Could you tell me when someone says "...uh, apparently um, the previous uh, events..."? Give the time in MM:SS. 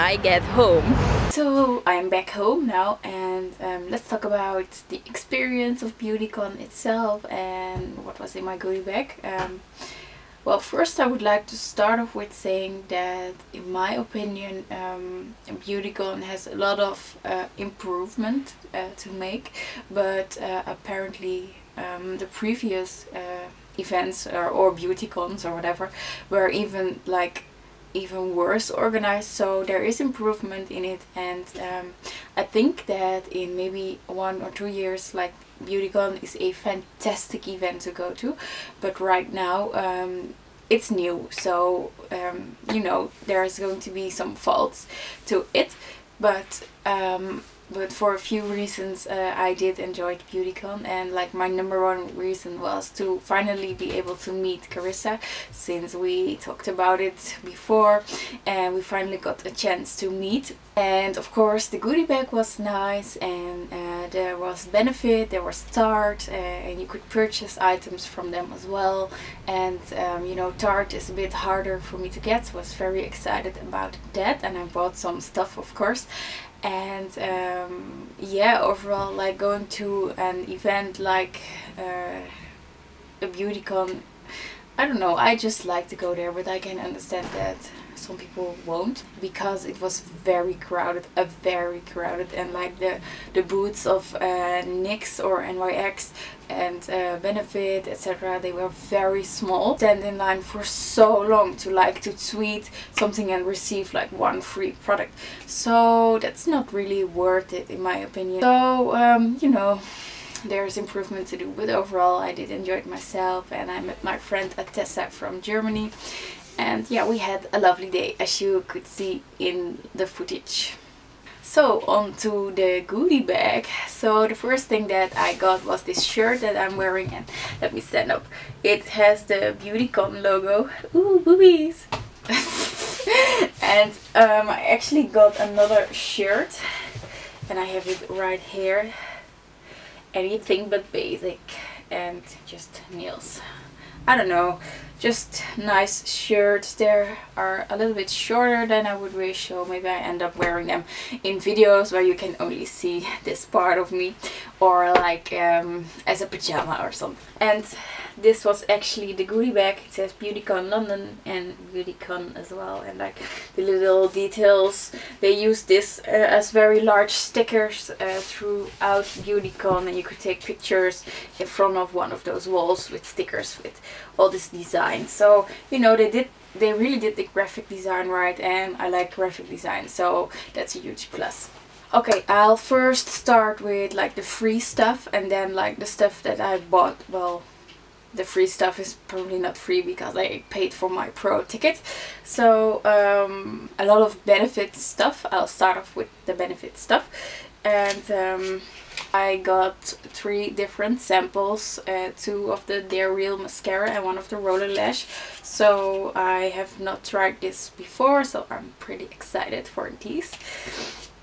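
00:20.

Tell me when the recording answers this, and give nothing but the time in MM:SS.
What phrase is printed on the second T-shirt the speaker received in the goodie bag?
02:20.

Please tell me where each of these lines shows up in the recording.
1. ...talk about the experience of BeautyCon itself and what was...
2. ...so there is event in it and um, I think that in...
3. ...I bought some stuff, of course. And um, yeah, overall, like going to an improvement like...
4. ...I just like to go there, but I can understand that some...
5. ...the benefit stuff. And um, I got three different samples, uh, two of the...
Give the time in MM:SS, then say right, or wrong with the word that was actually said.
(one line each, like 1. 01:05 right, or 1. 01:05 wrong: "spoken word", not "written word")
1. 00:04 right
2. 00:29 wrong: "improvement", not "event"
3. 01:14 wrong: "event", not "improvement"
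4. 01:25 right
5. 03:16 right.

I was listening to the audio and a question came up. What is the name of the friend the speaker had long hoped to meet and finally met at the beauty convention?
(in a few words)
Carissa.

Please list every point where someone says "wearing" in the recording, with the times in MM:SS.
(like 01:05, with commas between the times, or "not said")
02:06, 02:30.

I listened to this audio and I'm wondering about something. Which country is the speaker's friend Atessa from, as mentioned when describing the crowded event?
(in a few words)
Germany.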